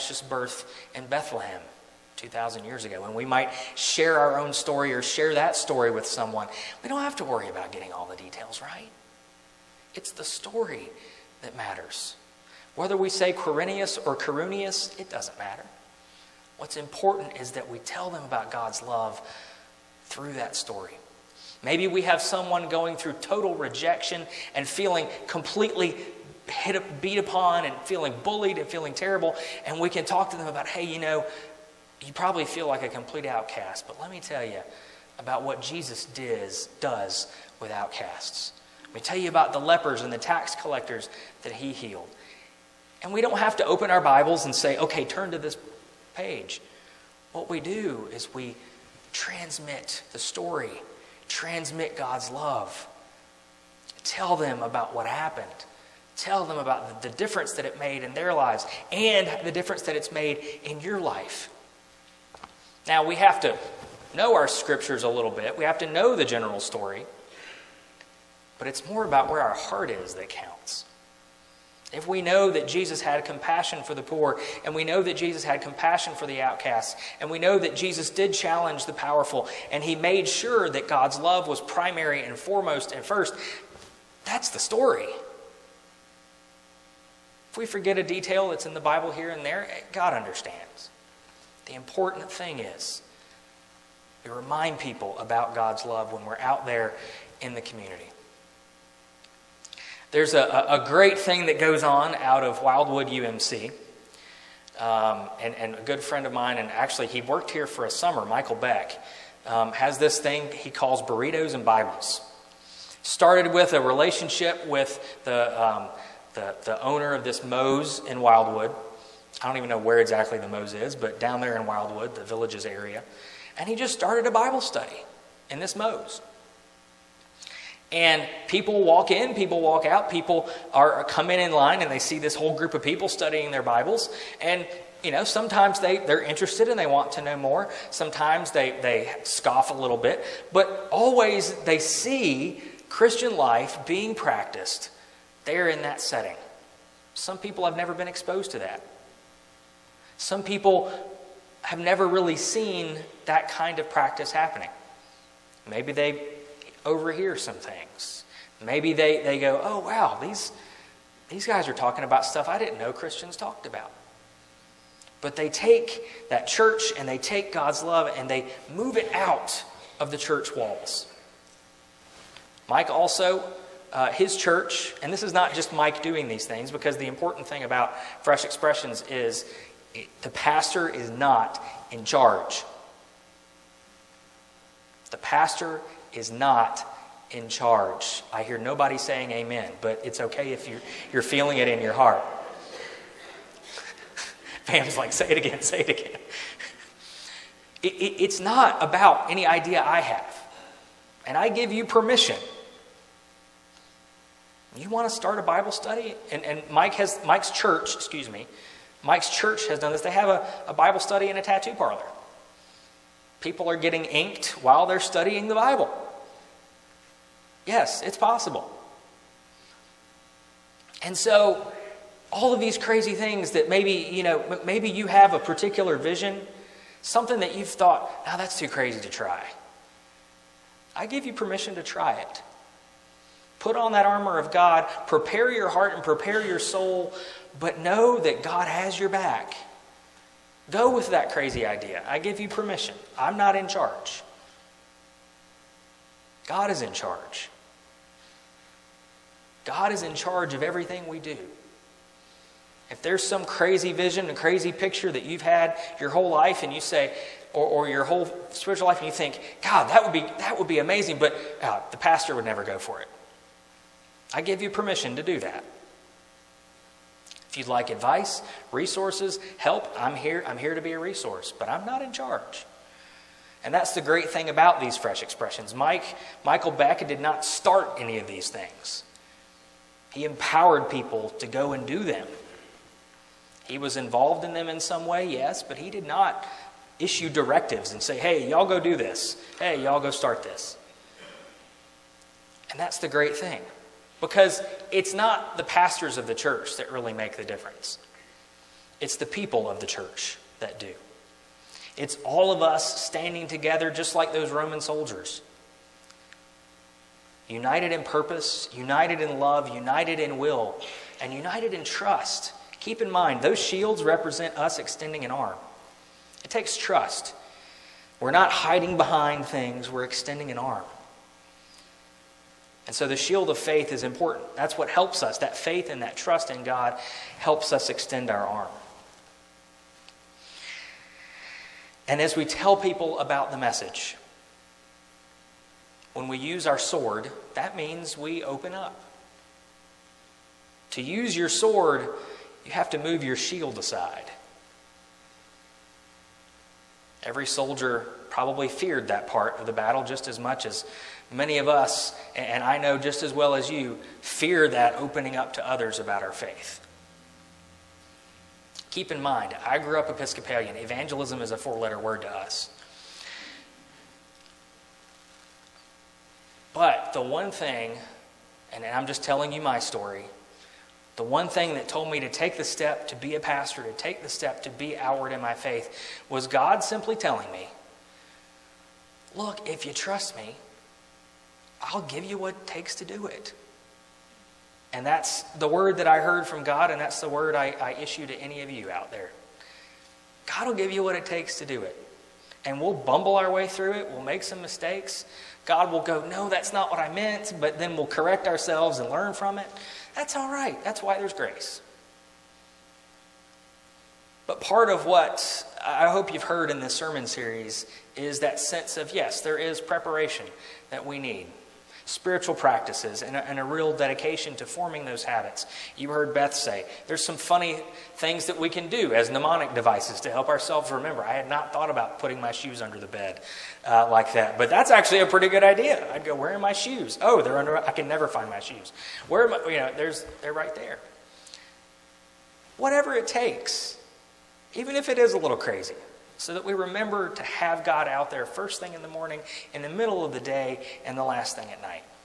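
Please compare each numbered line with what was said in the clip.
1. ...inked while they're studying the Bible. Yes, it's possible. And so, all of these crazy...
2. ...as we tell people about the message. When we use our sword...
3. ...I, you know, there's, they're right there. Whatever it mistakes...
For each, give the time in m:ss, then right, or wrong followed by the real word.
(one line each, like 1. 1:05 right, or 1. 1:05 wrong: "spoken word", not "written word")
1. 3:34 right
2. 5:32 right
3. 7:09 wrong: "takes", not "mistakes".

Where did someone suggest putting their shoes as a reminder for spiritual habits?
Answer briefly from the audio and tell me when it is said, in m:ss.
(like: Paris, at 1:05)
Under the bed, at 7:02.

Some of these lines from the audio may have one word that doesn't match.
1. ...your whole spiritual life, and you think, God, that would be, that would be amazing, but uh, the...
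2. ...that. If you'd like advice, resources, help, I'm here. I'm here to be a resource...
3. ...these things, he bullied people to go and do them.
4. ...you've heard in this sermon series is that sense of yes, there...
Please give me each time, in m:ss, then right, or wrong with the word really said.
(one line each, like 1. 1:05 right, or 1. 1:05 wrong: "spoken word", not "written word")
1. 4:17 right
2. 4:25 right
3. 4:38 wrong: "empowered", not "bullied"
4. 6:46 right.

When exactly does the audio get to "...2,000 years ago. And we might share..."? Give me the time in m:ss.
0:02.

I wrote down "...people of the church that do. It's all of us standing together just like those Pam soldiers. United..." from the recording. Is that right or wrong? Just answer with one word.
wrong.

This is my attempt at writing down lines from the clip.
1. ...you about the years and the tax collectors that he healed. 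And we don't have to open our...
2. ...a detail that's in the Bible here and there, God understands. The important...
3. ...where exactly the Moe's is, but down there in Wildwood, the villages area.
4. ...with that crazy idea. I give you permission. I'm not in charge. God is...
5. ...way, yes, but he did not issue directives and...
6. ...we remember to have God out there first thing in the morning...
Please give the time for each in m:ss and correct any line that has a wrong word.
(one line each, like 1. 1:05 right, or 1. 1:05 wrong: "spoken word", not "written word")
1. 0:39 wrong: "lepers", not "years"
2. 1:27 right
3. 1:59 right
4. 4:00 right
5. 4:45 right
6. 7:16 right.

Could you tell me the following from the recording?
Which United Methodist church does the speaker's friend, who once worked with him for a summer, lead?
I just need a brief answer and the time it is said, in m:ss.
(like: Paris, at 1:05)
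Wildwood UMC, at 1:42.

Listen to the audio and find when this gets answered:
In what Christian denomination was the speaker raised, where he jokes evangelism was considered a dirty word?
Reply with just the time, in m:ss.
6:00.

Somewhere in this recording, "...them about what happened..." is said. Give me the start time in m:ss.
0:54.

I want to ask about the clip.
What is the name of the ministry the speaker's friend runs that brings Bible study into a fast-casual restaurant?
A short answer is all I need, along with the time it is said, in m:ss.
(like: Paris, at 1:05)
Burritos and Bibles, at 1:51.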